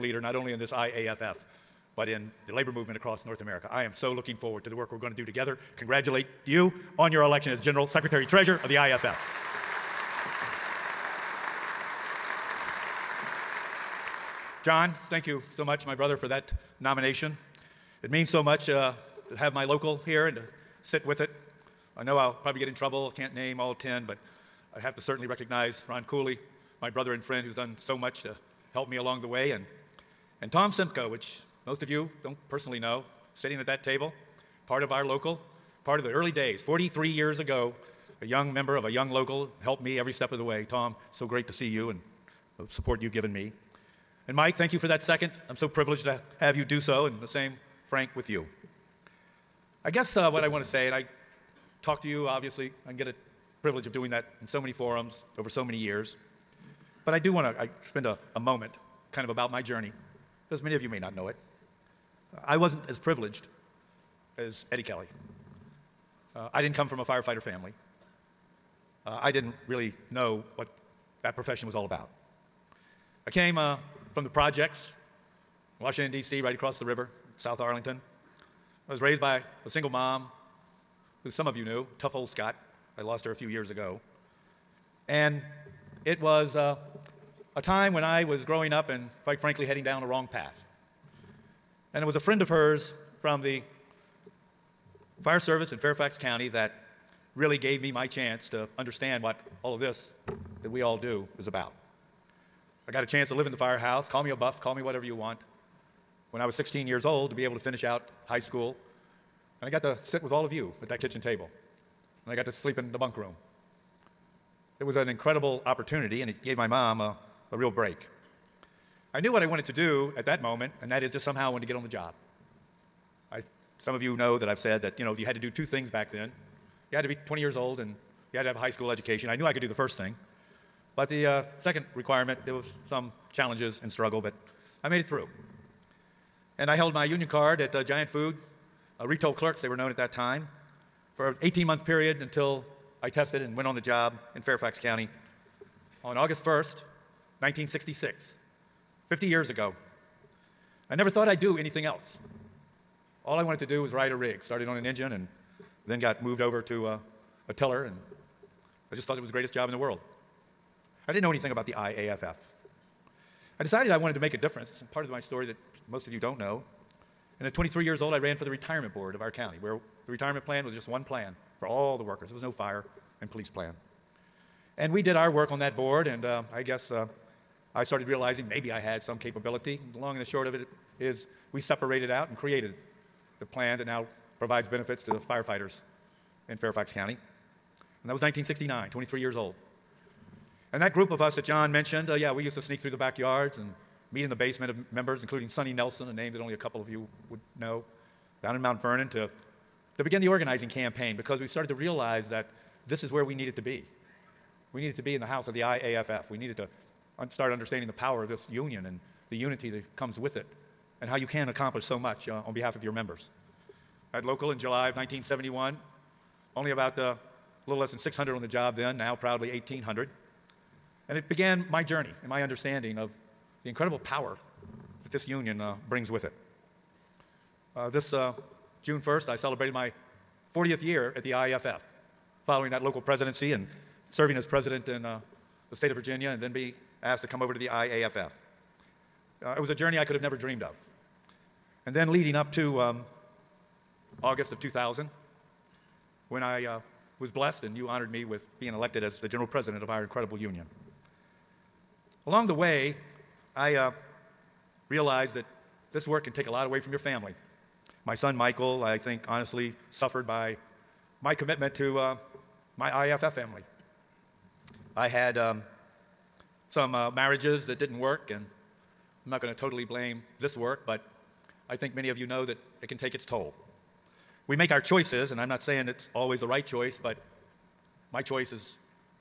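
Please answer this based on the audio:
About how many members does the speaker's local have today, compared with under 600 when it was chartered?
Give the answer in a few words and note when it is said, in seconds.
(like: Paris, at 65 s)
1,800, at 219 s.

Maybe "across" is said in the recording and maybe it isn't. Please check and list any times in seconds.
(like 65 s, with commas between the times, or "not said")
2 s, 76 s.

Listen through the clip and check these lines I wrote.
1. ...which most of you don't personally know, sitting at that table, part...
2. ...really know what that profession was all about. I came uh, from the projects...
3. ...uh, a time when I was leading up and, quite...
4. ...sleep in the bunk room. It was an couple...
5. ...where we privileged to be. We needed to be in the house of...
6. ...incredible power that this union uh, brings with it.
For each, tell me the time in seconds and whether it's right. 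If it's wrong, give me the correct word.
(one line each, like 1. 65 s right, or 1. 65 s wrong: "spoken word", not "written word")
1. 31 s right
2. 69 s right
3. 86 s wrong: "growing", not "leading"
4. 112 s wrong: "incredible", not "couple"
5. 203 s wrong: "needed", not "privileged"
6. 223 s right.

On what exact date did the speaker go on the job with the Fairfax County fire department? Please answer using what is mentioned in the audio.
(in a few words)
August 1, 1966.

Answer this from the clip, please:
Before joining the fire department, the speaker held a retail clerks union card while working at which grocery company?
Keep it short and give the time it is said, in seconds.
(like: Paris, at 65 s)
Giant Food, at 137 s.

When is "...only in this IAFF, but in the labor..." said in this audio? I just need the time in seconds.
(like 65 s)
0 s.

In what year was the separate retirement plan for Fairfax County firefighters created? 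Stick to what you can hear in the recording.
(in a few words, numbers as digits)
1969.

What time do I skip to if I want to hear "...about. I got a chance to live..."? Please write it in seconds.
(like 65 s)
101 s.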